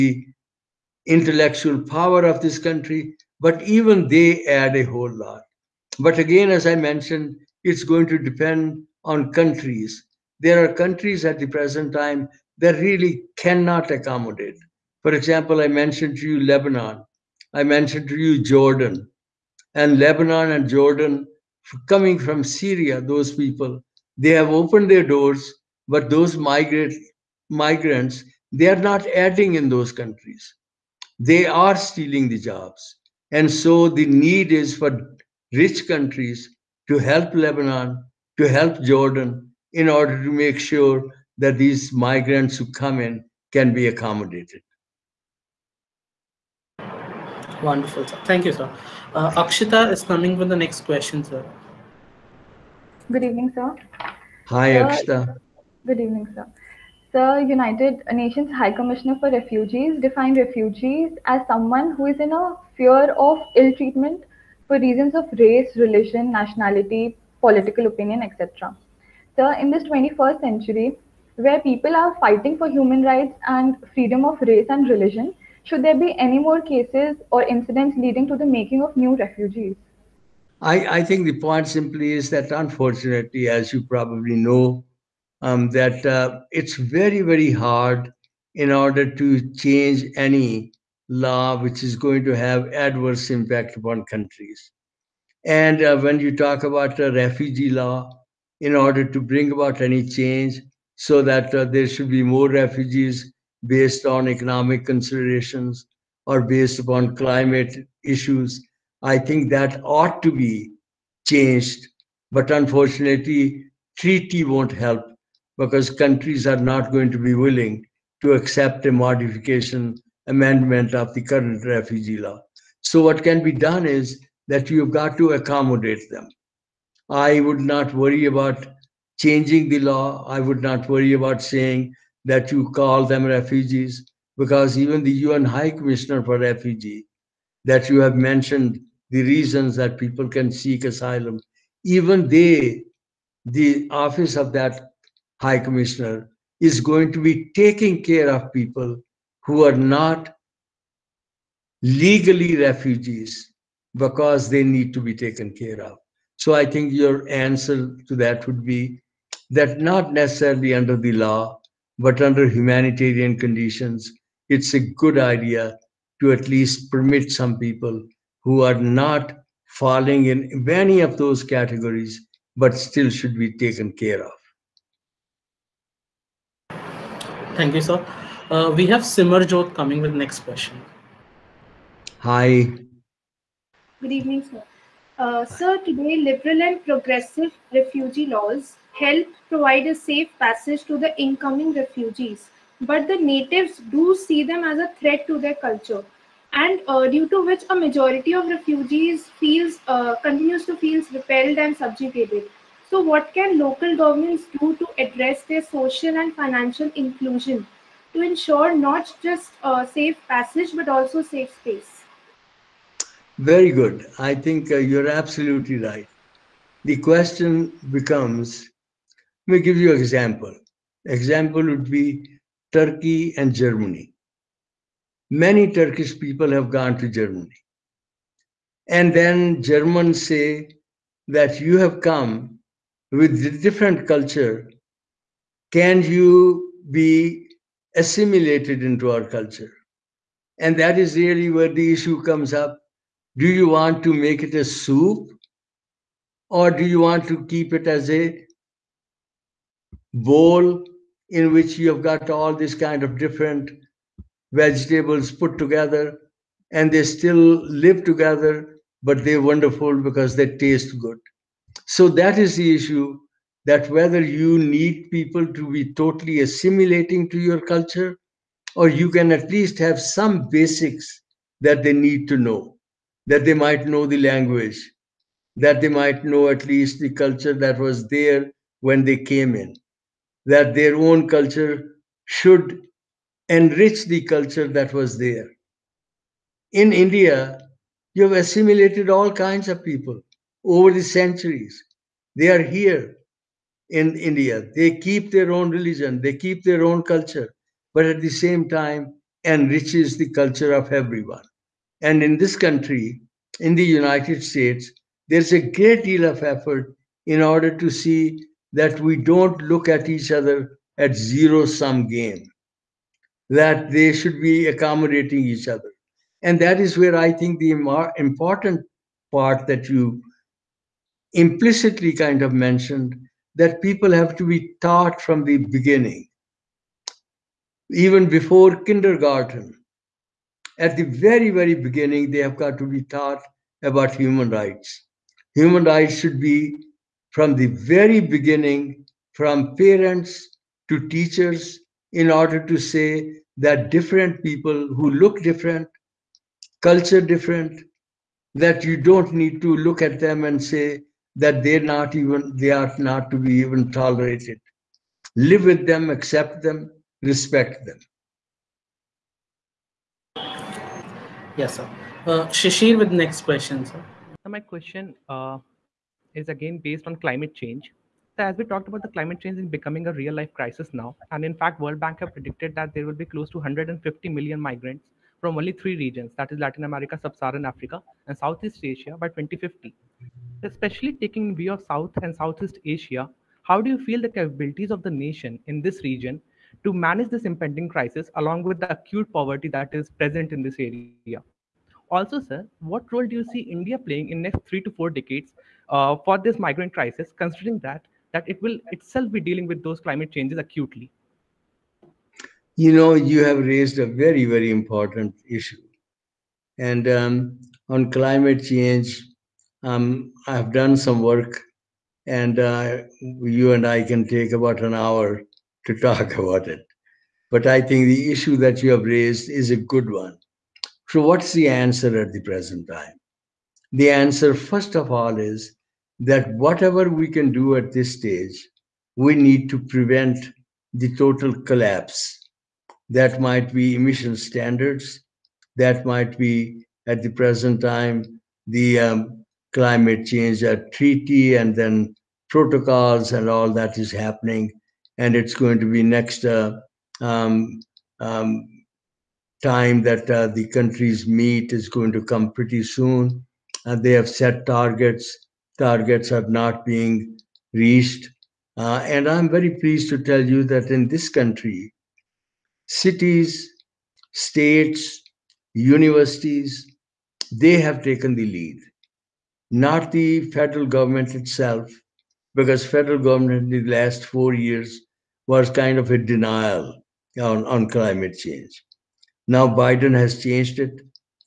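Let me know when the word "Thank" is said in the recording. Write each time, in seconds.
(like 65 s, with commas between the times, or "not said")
48 s, 177 s.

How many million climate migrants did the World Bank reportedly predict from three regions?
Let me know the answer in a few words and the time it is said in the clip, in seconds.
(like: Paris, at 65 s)
150 million, at 373 s.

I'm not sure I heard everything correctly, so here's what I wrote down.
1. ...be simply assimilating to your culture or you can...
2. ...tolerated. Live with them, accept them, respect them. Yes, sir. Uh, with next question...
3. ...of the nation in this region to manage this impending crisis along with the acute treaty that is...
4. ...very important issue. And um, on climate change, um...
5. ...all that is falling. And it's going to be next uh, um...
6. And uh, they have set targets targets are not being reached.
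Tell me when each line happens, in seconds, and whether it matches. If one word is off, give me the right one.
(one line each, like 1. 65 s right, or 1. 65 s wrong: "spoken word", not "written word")
1. 265 s wrong: "totally", not "simply"
2. 353 s right
3. 384 s wrong: "poverty", not "treaty"
4. 404 s right
5. 443 s wrong: "happening", not "falling"
6. 453 s right.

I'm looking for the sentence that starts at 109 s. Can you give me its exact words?
I think that ought to be changed.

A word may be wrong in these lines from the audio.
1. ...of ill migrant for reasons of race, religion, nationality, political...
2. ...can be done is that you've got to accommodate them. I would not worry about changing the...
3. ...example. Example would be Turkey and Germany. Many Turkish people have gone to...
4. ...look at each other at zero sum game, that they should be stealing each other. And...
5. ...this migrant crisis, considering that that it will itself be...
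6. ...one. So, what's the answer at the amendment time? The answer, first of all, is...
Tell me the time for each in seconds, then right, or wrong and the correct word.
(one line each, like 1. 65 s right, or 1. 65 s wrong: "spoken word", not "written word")
1. 63 s wrong: "treatment", not "migrant"
2. 123 s right
3. 219 s right
4. 309 s wrong: "accommodating", not "stealing"
5. 396 s right
6. 420 s wrong: "present", not "amendment".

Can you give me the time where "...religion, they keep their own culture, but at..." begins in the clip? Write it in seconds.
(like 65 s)
295 s.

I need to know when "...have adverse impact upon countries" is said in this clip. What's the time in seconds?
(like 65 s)
92 s.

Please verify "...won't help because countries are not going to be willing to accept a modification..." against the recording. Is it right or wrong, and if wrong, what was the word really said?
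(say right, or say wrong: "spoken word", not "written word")
right.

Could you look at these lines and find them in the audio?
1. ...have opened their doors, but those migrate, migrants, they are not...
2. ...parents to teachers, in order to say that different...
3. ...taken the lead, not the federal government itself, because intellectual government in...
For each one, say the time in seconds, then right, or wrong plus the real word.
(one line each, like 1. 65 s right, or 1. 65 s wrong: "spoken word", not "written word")
1. 24 s right
2. 339 s right
3. 468 s wrong: "federal", not "intellectual".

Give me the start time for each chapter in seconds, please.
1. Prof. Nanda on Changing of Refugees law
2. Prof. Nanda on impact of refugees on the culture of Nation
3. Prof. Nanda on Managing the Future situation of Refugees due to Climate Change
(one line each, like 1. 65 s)
1. 85 s
2. 213 s
3. 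403 s.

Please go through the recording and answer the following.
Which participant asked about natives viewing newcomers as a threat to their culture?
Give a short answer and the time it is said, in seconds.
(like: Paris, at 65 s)
Simarjot, at 179 s.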